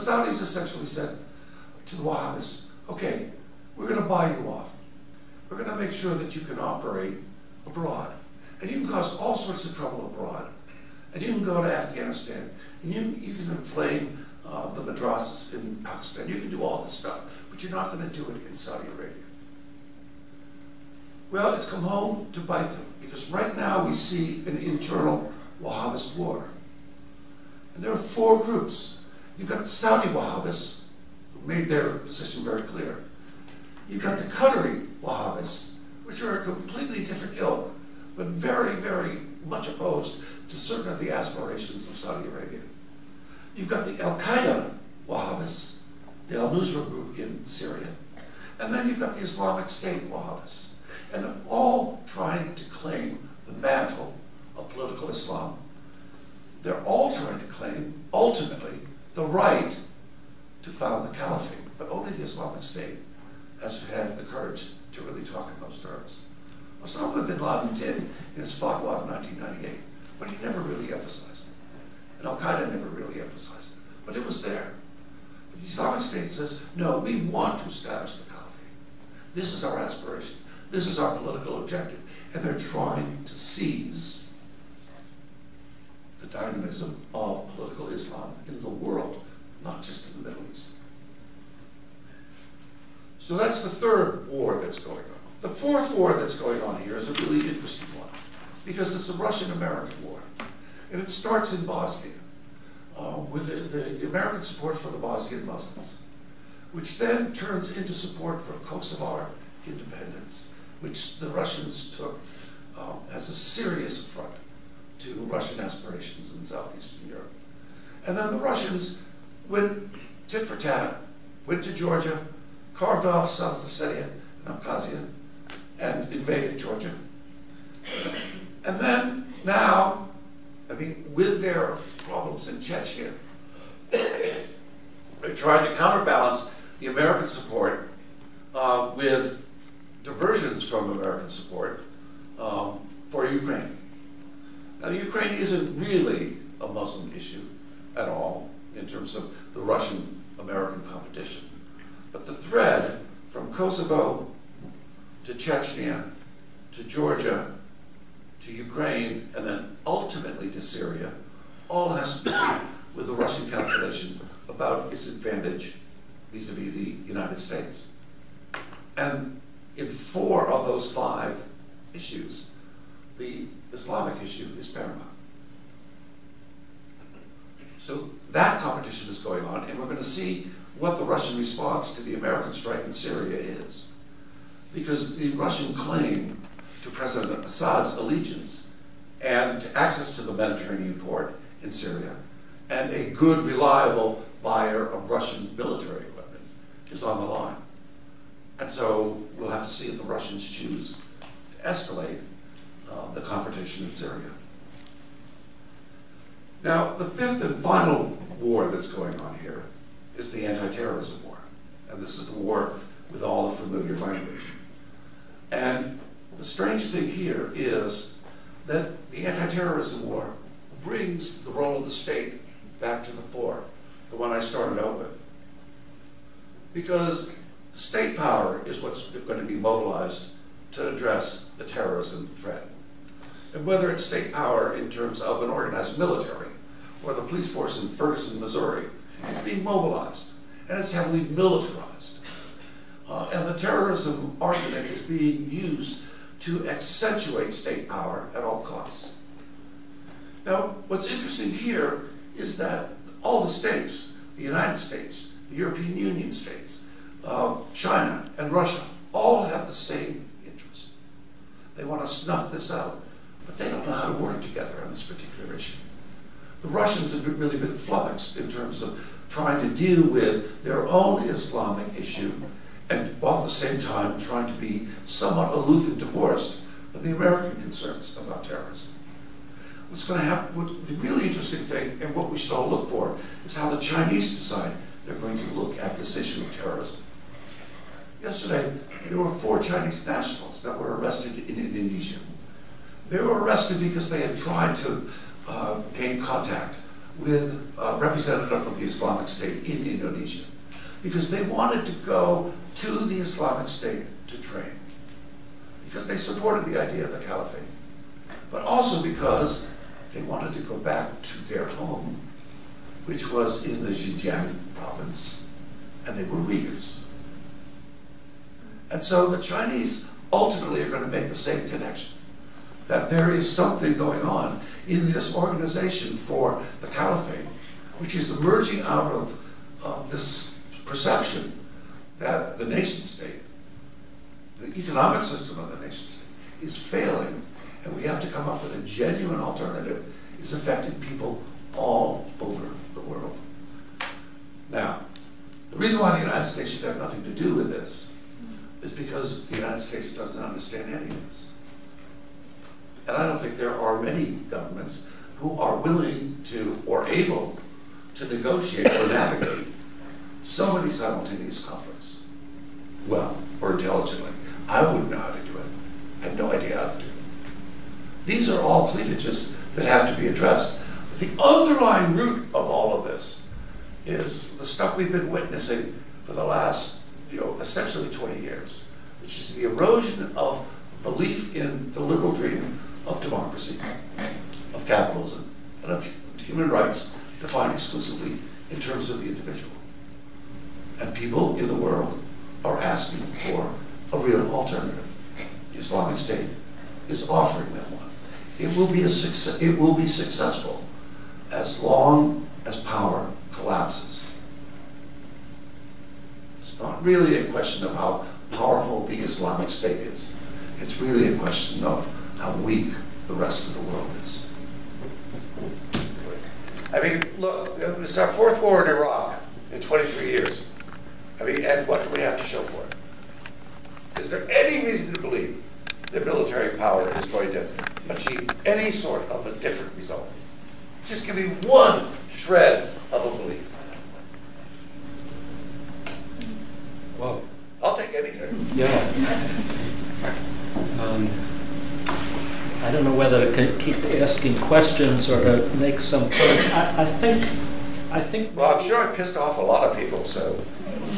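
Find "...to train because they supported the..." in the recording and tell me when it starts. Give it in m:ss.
5:04.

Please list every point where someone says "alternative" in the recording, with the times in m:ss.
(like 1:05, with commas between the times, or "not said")
5:39, 6:34.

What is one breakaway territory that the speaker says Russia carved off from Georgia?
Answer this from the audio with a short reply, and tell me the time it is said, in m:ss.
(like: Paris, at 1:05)
South Ossetia, at 2:03.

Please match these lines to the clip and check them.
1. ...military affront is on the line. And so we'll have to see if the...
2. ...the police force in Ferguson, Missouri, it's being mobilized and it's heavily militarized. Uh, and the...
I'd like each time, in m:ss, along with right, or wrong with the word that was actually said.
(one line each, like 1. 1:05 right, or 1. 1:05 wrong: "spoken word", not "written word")
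1. 3:15 wrong: "equipment", not "affront"
2. 3:57 right.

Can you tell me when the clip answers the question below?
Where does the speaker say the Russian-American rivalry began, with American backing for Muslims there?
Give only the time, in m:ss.
1:41.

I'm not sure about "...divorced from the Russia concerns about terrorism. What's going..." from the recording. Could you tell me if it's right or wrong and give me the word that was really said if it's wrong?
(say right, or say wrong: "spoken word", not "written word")
wrong: "American", not "Russia".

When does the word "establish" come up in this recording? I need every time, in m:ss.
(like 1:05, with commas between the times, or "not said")
1:17.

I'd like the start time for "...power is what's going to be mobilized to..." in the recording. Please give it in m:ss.
3:48.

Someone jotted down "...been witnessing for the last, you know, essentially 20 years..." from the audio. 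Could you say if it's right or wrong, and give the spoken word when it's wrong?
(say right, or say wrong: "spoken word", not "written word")
right.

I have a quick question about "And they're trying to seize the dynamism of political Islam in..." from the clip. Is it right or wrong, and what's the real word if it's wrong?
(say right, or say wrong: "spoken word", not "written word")
right.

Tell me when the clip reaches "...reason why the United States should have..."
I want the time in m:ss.
5:45.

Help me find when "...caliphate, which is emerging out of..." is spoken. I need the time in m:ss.
5:26.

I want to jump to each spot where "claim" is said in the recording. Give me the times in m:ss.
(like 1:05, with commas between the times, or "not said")
0:52, 0:57, 3:05.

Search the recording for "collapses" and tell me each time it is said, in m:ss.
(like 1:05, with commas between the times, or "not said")
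6:43.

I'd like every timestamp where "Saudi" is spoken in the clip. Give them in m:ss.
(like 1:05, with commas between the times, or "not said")
0:18, 0:29, 0:41.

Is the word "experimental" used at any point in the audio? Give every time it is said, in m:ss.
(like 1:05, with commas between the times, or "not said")
not said.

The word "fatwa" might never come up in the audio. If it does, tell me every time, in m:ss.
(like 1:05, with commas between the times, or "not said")
1:08.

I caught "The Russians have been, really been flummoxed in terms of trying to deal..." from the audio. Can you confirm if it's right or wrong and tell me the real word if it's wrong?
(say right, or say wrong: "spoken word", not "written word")
right.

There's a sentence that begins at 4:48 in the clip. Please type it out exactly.
Yesterday, there were four Chinese nationals that were arrested in Indonesia.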